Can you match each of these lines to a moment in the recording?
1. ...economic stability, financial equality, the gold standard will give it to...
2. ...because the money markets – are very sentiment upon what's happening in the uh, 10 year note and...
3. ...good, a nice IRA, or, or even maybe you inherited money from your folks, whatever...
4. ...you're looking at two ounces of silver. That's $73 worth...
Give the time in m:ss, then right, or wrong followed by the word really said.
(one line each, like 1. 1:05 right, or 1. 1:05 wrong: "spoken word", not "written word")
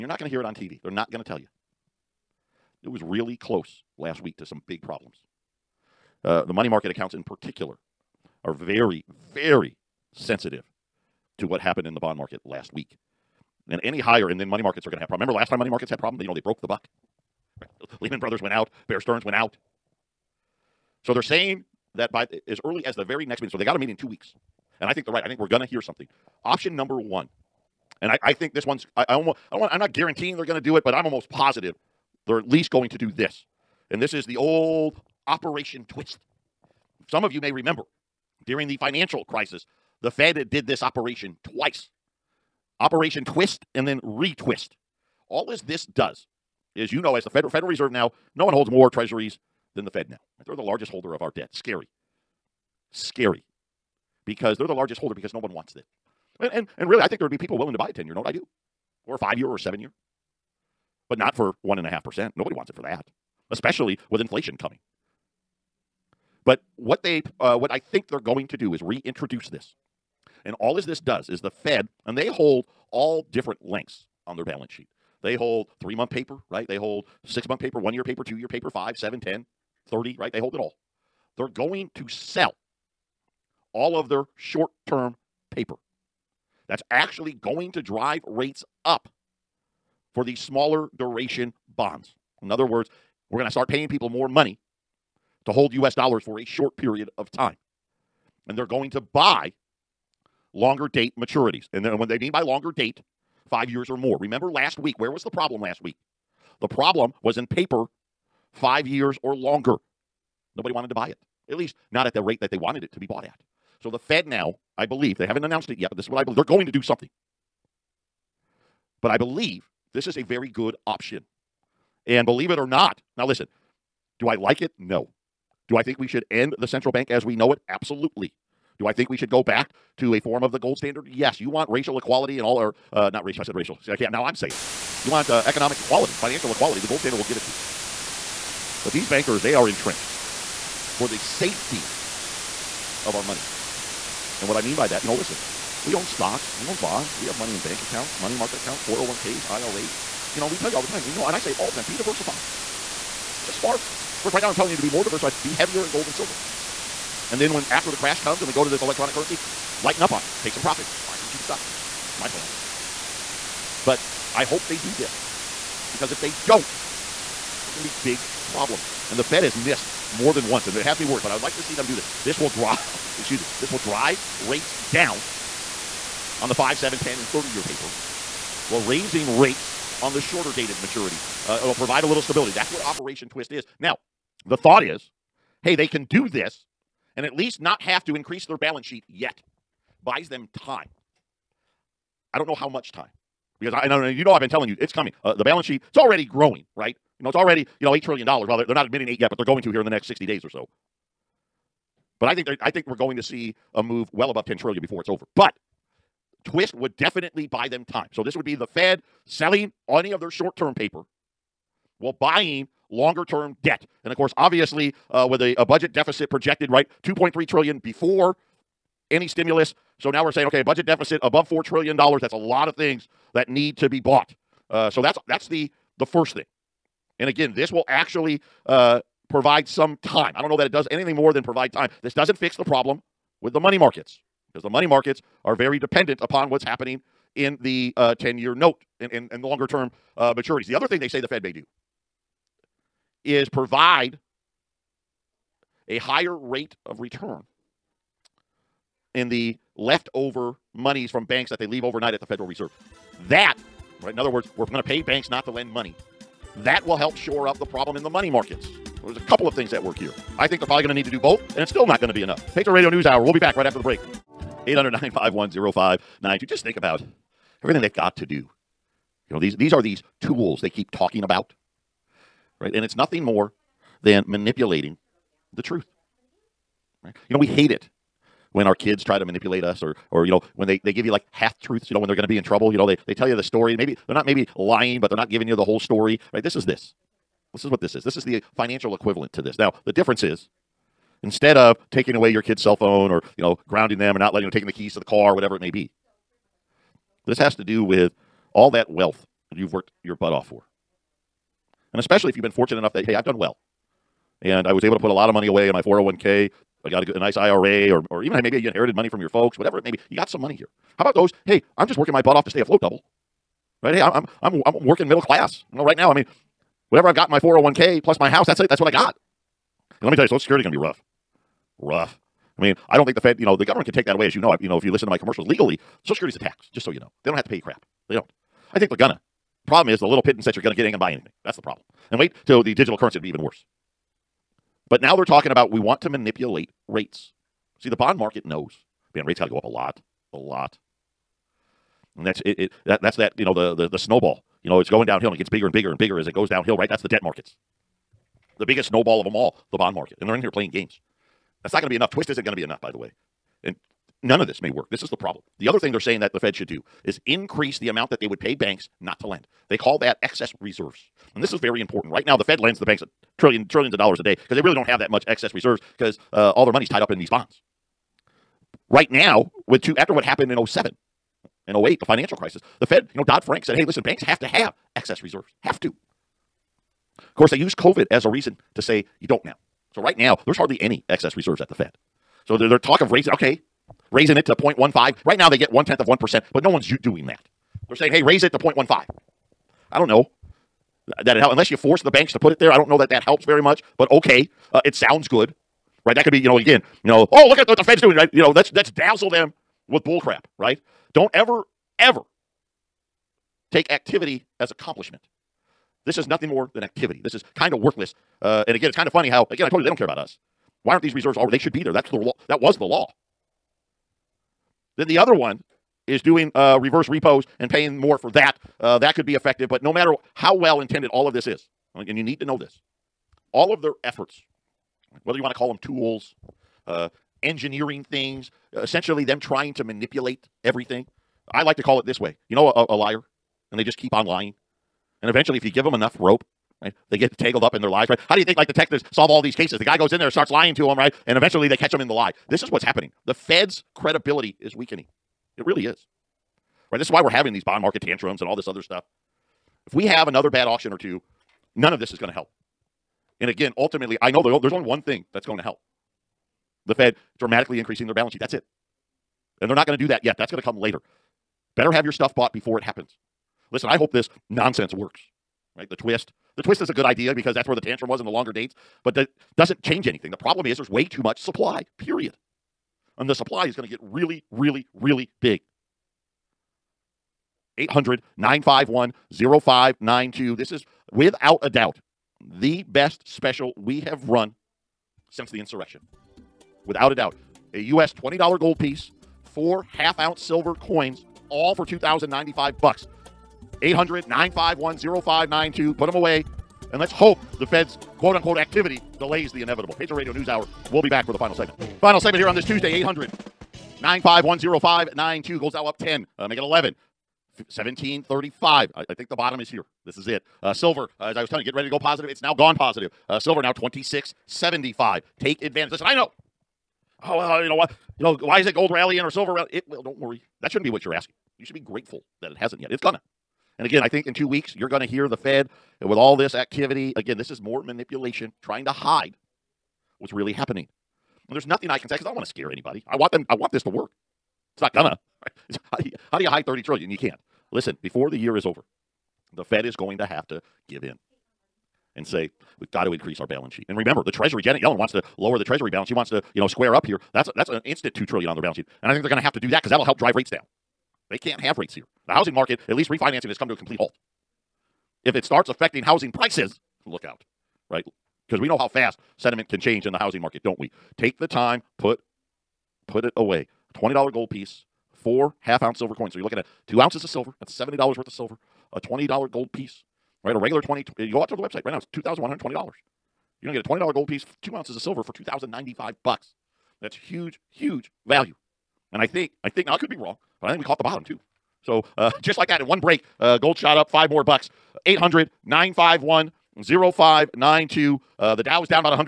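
1. 2:15 wrong: "equality", not "stability"
2. 3:54 wrong: "dependent", not "sentiment"
3. 5:07 right
4. 9:26 wrong: "70", not "73".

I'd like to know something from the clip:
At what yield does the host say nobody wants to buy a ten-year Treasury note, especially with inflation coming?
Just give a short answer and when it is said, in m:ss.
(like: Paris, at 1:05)
1.5%, at 1:01.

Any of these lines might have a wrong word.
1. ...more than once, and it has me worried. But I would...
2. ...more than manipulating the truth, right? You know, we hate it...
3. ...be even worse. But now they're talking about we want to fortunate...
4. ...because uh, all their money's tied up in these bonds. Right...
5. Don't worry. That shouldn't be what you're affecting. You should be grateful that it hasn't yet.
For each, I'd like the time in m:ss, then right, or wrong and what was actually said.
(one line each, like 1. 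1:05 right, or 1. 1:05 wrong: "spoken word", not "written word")
1. 2:50 right
2. 4:33 right
3. 5:33 wrong: "manipulate", not "fortunate"
4. 6:05 right
5. 8:40 wrong: "asking", not "affecting".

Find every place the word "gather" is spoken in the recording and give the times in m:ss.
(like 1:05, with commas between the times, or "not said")
not said.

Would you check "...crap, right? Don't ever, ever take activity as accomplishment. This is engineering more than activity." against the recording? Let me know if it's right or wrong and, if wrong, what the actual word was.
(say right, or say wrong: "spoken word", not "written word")
wrong: "nothing", not "engineering".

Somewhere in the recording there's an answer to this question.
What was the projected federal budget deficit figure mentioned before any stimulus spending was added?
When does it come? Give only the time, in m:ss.
3:37.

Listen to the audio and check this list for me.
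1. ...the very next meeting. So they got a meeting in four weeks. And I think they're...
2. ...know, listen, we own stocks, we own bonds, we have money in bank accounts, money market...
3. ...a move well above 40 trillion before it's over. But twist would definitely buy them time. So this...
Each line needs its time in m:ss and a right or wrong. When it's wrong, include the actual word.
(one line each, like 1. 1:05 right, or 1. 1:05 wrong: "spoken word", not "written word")
1. 0:22 wrong: "two", not "four"
2. 2:25 right
3. 3:23 wrong: "10", not "40".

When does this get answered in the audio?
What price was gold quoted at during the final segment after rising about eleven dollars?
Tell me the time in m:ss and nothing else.
8:27.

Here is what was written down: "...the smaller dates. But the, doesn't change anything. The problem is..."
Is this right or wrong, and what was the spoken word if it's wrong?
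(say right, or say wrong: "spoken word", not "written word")
wrong: "longer", not "smaller".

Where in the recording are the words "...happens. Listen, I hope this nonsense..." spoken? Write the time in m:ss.
7:42.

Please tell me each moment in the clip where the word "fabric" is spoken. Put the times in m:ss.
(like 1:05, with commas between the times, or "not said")
not said.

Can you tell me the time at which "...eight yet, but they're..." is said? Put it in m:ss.
3:19.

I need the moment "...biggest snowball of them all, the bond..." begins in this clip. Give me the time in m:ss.
5:48.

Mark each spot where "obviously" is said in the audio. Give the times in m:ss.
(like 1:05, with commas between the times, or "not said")
3:34.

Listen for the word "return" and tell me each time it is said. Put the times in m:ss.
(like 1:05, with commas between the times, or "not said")
4:06.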